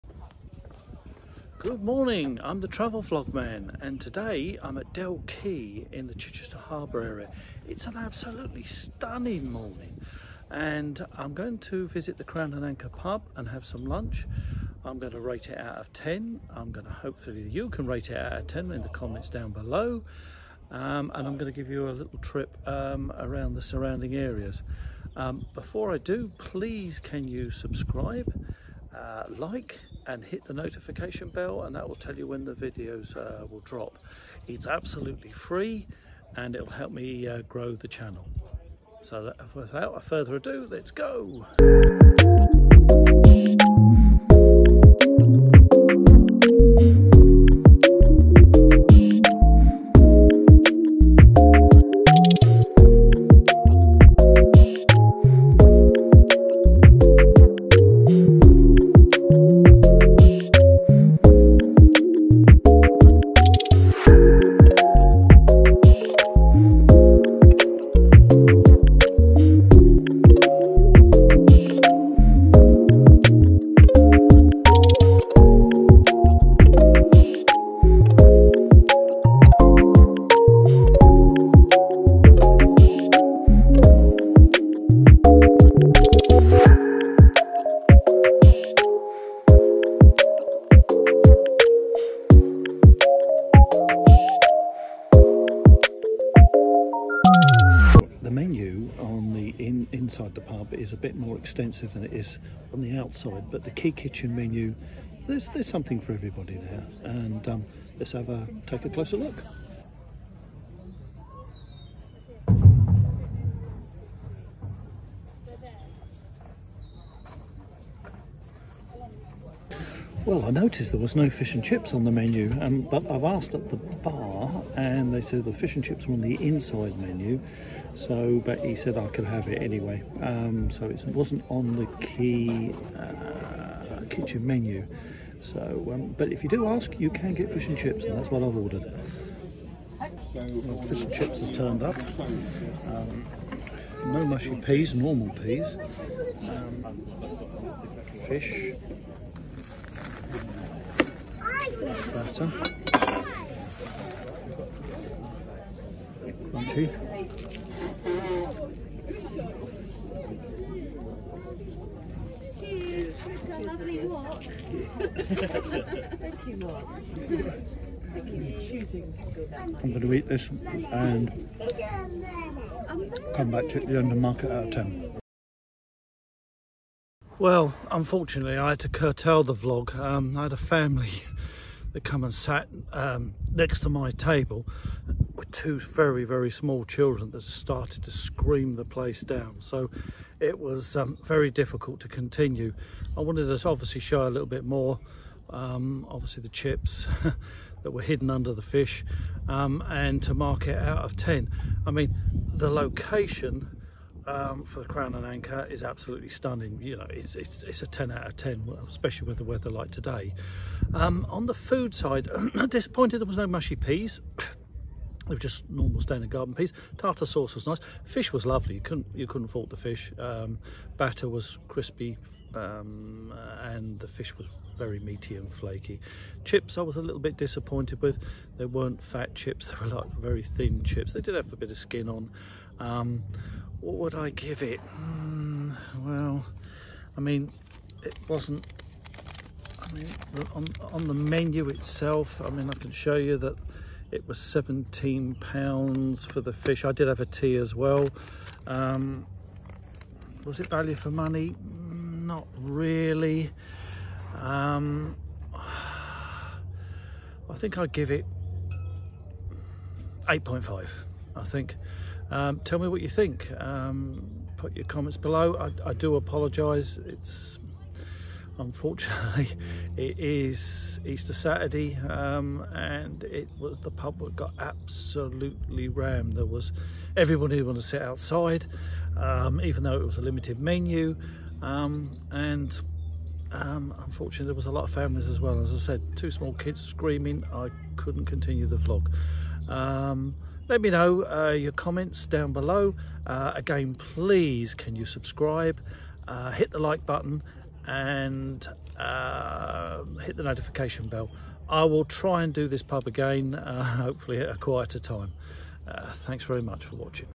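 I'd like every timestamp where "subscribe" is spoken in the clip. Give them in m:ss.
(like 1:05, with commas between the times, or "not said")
0:27, 4:55.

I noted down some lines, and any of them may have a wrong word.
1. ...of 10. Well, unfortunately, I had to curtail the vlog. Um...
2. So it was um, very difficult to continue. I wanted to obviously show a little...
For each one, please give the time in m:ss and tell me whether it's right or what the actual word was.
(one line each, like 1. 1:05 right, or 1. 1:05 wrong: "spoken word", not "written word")
1. 2:54 right
2. 3:09 right.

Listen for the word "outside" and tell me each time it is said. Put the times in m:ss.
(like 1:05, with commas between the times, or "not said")
1:42, 4:38.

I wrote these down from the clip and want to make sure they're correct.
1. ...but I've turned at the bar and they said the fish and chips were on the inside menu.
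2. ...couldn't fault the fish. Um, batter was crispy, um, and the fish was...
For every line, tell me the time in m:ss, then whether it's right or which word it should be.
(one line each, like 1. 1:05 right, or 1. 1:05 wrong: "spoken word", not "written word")
1. 2:02 wrong: "asked", not "turned"
2. 3:39 right.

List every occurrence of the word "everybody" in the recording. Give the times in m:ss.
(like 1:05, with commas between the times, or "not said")
1:46, 4:37.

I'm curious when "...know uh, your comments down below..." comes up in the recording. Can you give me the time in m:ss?
4:50.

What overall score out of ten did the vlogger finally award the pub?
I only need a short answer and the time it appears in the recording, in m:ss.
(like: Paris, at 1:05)
8.5, at 4:20.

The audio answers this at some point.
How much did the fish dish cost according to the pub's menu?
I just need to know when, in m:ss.
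4:04.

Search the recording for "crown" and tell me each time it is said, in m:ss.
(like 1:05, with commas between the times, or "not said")
0:12, 3:24.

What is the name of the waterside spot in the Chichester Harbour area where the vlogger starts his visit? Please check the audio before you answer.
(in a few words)
Dell Quay.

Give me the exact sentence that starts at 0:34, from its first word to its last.
It's absolutely free and it'll help me uh, grow the channel.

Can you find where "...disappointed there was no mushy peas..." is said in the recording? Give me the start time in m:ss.
3:32.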